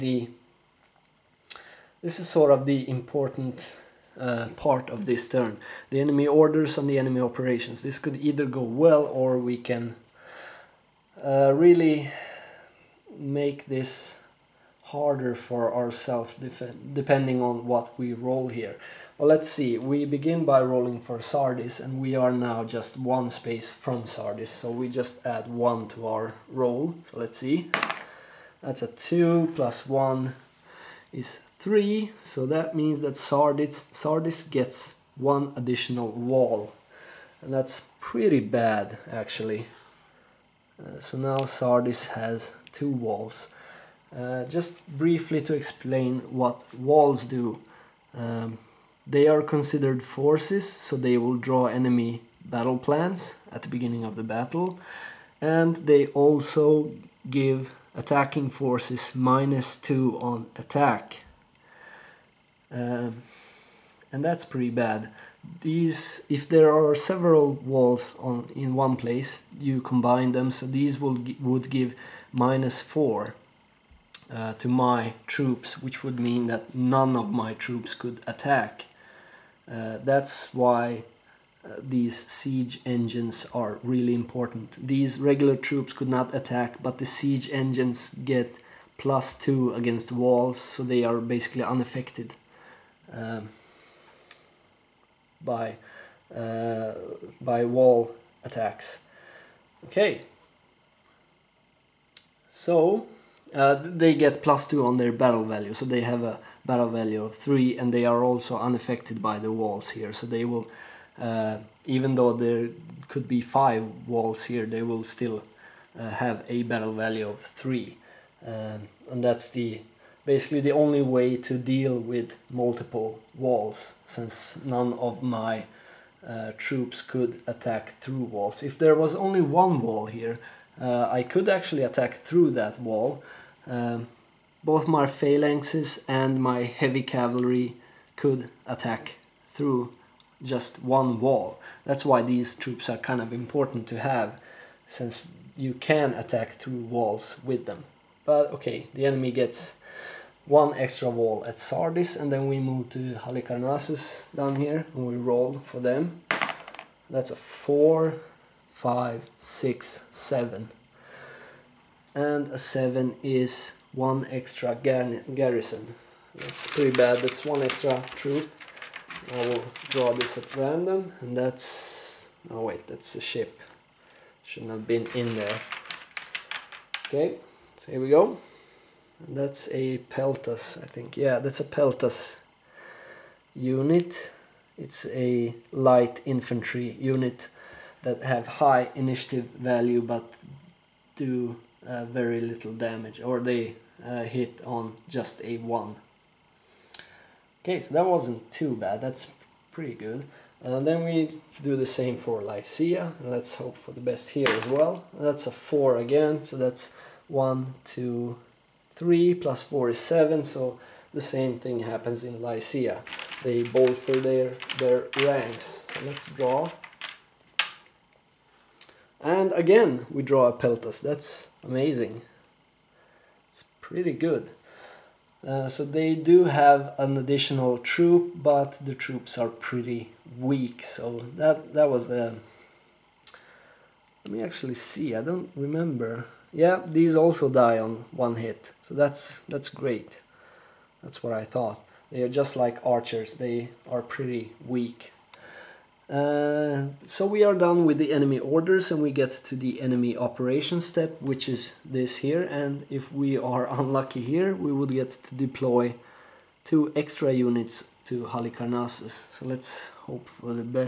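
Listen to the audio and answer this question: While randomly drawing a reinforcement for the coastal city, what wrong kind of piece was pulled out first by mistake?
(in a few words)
a ship.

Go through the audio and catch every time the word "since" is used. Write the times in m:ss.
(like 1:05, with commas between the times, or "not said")
2:04, 2:24.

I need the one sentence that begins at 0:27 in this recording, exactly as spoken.
So let's see, that's a two plus one is three, so that means that Sardis, Sardis gets one additional wall.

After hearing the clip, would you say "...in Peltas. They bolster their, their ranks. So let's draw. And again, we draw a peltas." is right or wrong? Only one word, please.
wrong.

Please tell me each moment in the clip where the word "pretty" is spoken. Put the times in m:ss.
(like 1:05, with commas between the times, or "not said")
0:37, 1:04, 2:46, 3:19, 3:43, 3:49, 4:04.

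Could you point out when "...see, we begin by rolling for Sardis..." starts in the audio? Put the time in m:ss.
0:19.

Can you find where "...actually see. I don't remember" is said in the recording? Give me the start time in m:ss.
3:54.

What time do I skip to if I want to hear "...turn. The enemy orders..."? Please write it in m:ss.
0:05.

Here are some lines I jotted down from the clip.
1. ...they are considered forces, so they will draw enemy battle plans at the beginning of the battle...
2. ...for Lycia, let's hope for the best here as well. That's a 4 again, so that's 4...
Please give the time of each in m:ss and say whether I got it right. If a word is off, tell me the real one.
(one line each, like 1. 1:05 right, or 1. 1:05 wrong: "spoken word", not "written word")
1. 0:49 right
2. 3:22 wrong: "1", not "4".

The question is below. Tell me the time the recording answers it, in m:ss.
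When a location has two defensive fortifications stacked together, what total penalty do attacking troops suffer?
1:12.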